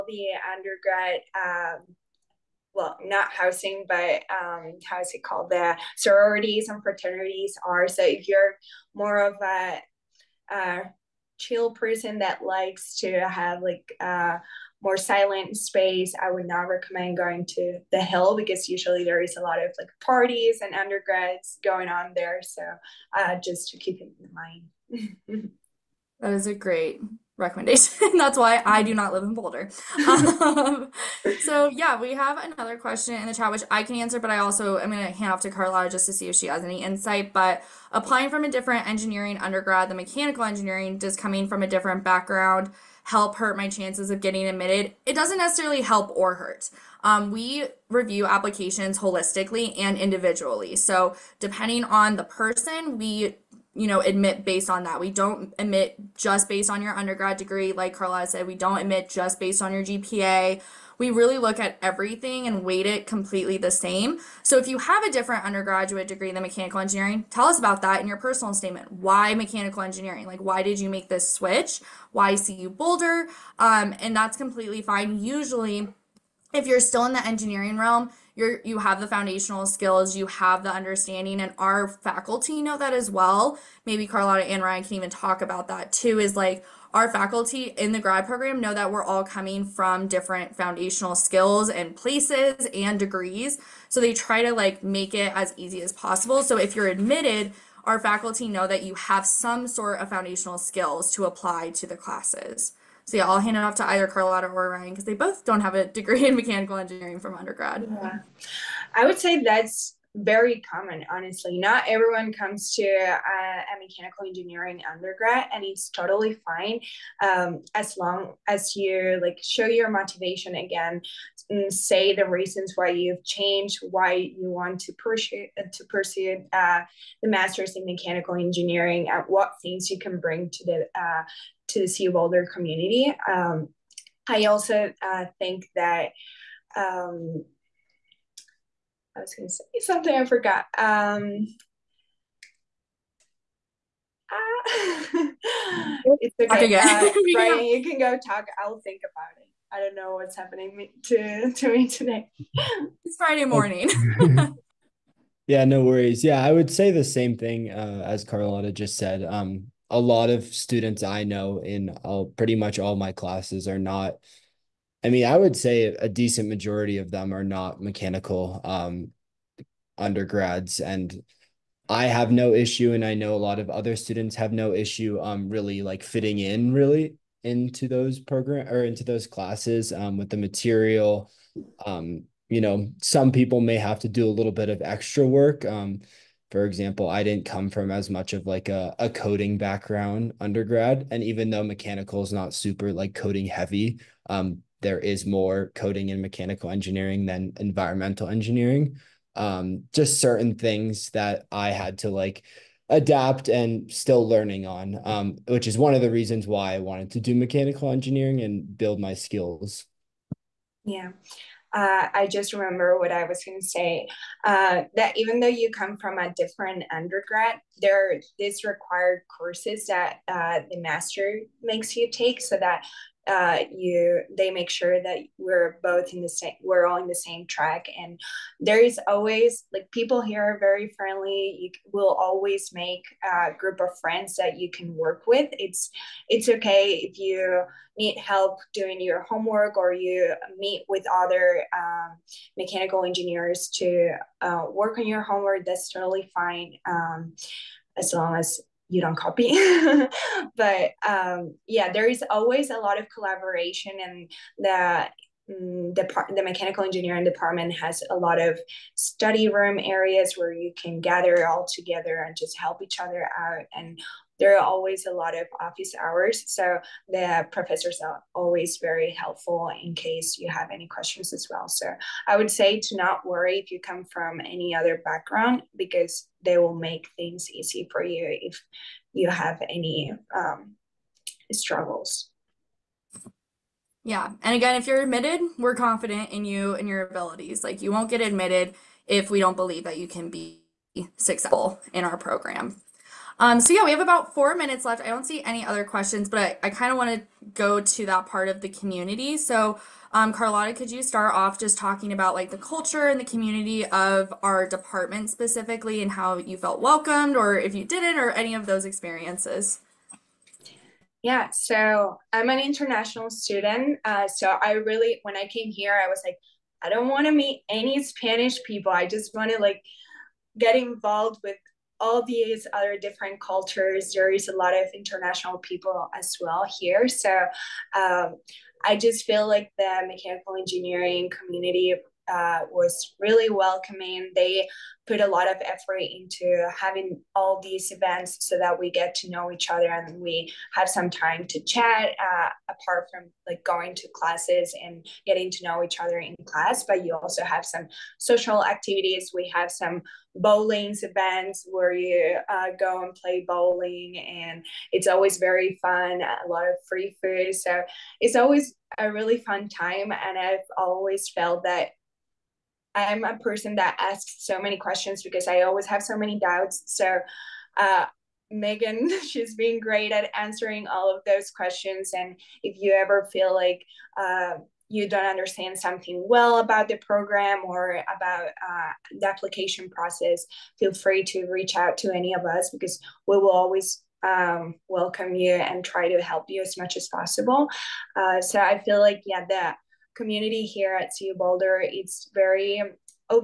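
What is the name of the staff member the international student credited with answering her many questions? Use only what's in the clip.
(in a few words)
Megan.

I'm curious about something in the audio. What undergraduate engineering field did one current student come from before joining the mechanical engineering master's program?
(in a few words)
environmental engineering.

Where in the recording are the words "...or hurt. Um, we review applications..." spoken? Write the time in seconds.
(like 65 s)
46 s.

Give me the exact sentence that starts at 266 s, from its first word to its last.
So the professors are always very helpful in case you have any questions as well.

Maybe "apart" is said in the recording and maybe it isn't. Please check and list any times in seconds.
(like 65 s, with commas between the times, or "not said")
342 s.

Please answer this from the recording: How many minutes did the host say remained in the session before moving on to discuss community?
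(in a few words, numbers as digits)
4.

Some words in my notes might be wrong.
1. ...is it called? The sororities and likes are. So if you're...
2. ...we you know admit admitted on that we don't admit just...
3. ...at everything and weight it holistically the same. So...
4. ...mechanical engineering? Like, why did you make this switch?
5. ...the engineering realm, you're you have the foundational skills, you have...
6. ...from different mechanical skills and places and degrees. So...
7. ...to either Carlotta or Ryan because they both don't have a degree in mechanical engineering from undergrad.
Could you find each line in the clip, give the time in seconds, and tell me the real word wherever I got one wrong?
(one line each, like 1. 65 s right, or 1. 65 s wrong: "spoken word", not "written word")
1. 5 s wrong: "fraternities", not "likes"
2. 52 s wrong: "based", not "admitted"
3. 61 s wrong: "completely", not "holistically"
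4. 69 s right
5. 77 s right
6. 89 s wrong: "foundational", not "mechanical"
7. 103 s right.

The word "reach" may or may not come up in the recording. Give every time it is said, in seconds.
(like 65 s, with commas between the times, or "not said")
381 s.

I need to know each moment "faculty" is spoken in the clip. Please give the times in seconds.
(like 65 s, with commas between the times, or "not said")
81 s, 87 s, 97 s.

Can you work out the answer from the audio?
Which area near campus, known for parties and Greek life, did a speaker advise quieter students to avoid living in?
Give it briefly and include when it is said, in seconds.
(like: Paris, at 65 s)
the hill, at 17 s.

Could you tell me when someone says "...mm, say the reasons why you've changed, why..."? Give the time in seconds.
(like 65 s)
121 s.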